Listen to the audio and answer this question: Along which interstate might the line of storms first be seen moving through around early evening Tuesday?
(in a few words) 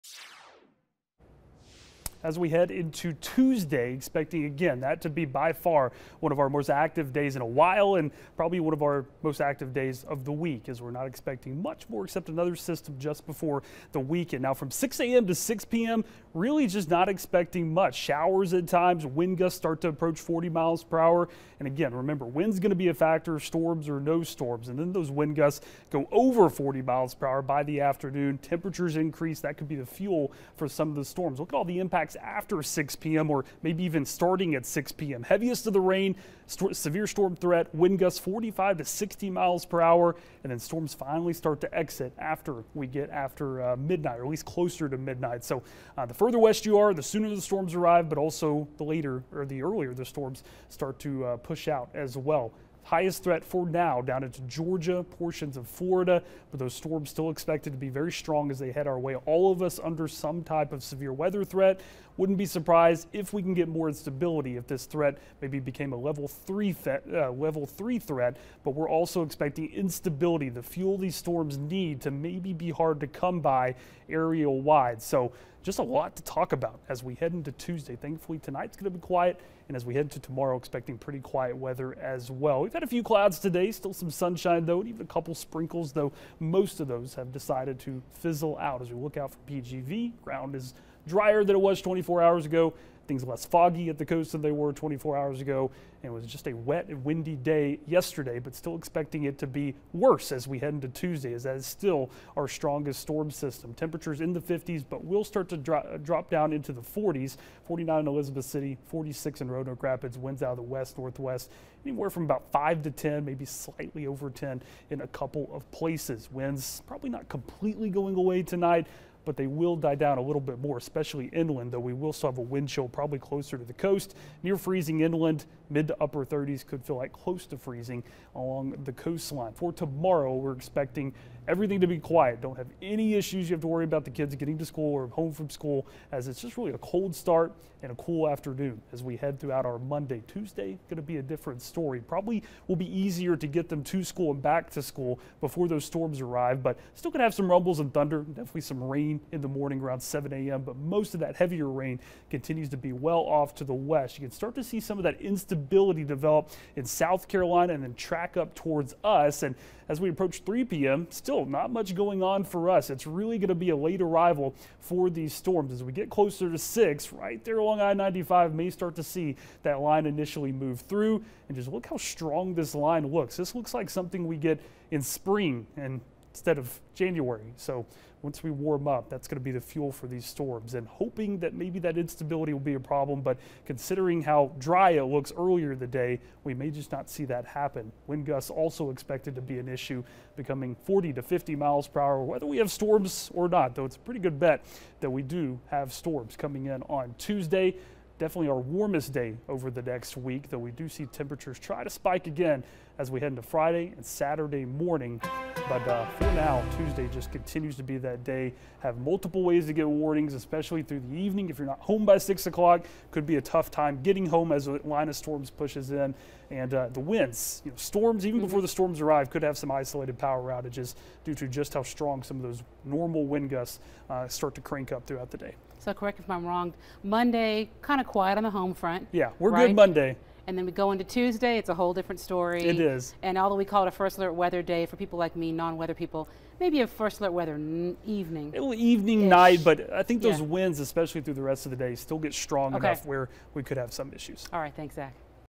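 I-95.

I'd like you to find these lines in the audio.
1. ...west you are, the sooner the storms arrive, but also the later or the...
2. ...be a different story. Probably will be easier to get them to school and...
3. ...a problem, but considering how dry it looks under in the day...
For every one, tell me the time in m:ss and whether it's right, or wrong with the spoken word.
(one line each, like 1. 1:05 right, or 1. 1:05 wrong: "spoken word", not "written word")
1. 0:46 right
2. 2:21 right
3. 3:02 wrong: "earlier", not "under".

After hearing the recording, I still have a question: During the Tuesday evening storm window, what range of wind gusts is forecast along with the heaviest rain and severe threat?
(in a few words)
45 to 60 mph.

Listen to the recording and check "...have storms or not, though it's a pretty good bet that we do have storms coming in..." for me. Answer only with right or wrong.
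right.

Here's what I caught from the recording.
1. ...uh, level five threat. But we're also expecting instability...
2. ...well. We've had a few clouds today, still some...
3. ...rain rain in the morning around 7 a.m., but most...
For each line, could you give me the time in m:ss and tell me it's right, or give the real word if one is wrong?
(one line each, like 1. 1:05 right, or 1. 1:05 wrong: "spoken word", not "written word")
1. 1:07 wrong: "three", not "five"
2. 1:22 right
3. 2:28 right.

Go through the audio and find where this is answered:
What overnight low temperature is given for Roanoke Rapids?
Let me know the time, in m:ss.
1:48.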